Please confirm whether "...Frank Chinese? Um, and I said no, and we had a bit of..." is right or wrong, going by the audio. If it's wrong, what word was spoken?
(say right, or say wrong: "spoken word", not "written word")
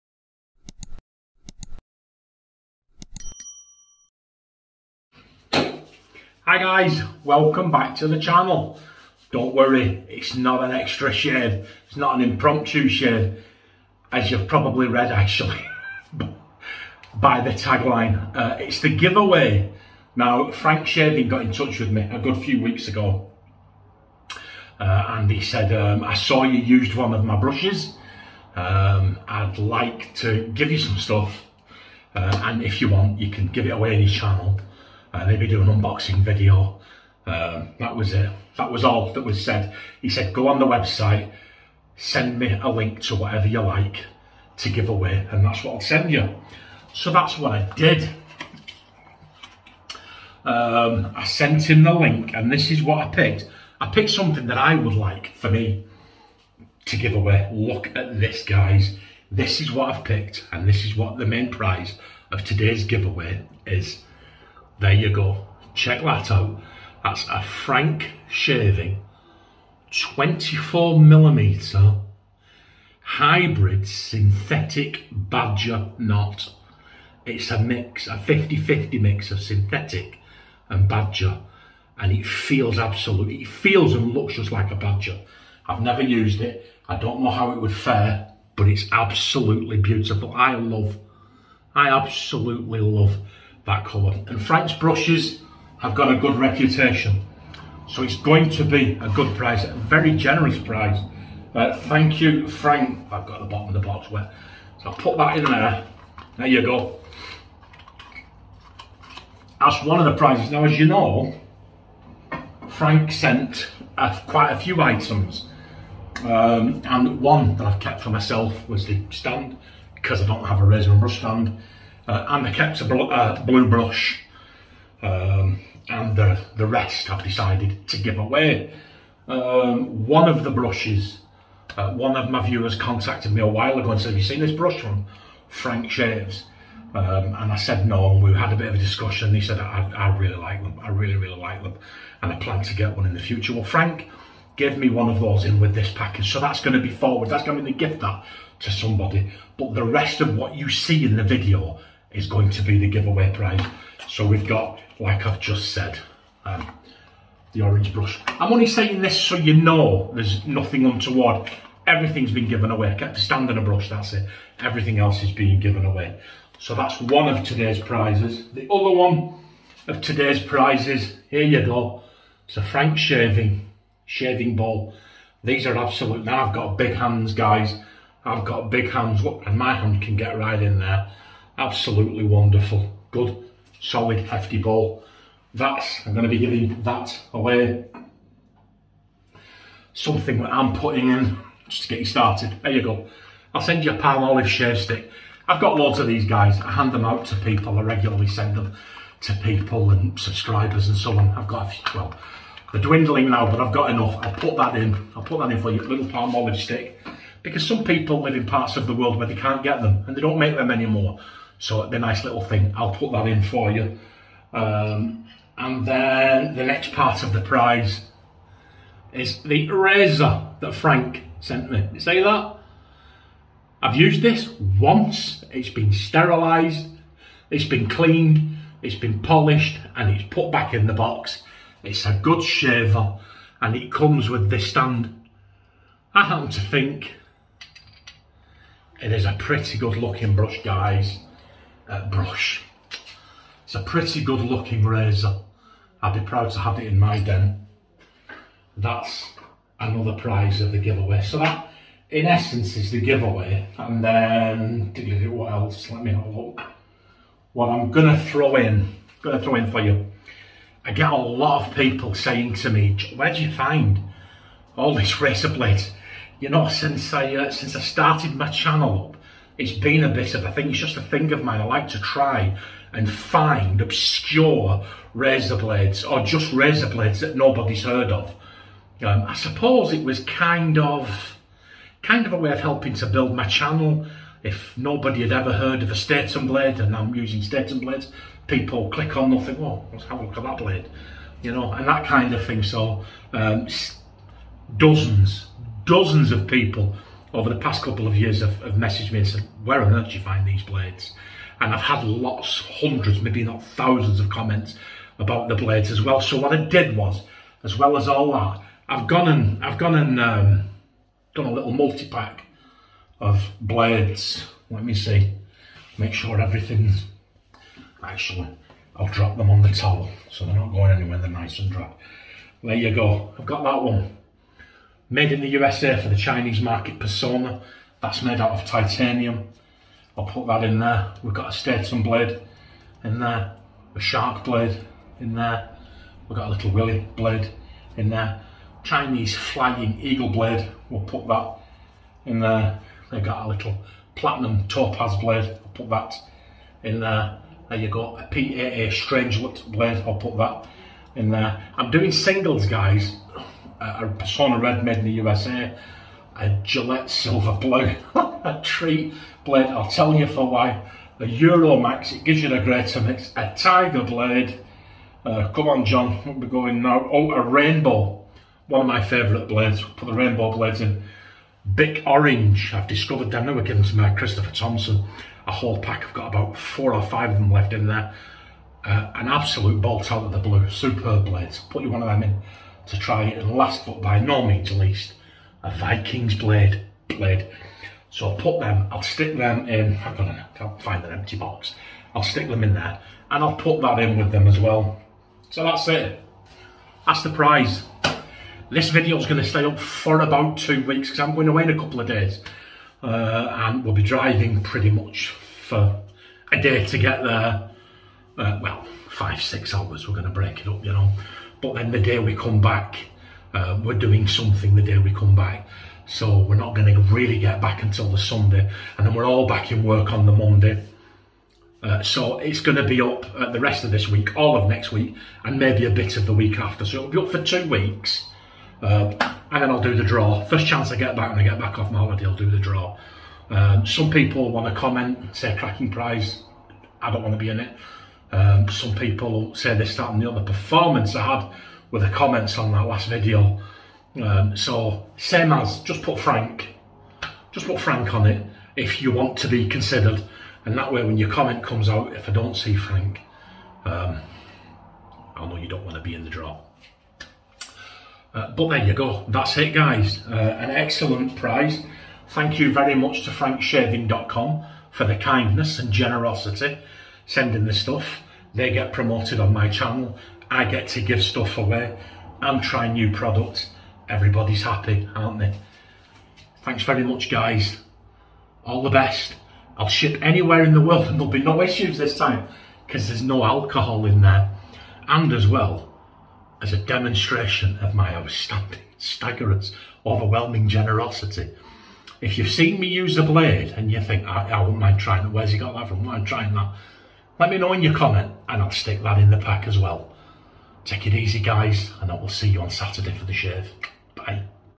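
wrong: "Shaves", not "Chinese".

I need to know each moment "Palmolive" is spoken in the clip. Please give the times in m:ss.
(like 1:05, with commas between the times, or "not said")
3:13, 3:26.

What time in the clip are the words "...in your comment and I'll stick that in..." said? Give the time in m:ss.
8:17.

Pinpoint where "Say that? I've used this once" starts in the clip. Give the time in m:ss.
3:41.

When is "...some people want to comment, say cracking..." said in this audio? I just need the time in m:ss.
7:13.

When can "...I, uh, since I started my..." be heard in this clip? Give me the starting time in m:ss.
4:27.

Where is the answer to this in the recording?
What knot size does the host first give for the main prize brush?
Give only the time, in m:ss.
1:09.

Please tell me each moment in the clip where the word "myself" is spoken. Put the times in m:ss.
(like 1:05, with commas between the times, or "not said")
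1:58.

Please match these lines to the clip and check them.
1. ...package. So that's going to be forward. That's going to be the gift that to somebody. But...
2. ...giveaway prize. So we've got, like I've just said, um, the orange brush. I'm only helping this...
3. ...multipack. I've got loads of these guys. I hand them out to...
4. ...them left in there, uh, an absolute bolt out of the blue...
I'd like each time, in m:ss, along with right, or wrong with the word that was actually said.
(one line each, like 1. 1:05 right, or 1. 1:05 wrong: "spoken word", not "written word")
1. 2:25 right
2. 2:32 wrong: "saying", not "helping"
3. 3:14 wrong: "stick", not "multipack"
4. 6:17 right.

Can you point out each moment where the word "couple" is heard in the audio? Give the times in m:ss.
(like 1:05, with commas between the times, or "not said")
4:57, 6:41.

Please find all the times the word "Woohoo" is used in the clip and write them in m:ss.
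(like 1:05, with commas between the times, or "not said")
not said.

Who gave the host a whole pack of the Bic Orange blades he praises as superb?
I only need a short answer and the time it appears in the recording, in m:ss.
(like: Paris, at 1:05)
Christopher Thompson, at 6:14.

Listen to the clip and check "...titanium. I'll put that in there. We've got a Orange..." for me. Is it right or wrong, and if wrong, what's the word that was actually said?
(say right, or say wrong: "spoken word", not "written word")
wrong: "Statum", not "Orange".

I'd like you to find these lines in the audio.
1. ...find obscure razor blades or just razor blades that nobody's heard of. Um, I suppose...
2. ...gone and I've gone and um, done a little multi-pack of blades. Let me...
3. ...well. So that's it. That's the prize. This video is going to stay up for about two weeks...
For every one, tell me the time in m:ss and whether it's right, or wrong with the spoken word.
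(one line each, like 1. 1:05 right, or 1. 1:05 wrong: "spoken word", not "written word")
1. 4:33 right
2. 5:09 right
3. 6:34 right.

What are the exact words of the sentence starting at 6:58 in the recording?
And then we're all back in work on the Monday.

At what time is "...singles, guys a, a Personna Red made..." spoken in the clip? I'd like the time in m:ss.
5:52.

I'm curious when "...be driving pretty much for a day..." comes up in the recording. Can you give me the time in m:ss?
6:43.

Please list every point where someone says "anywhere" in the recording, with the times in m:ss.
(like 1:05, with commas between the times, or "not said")
5:20, 8:00.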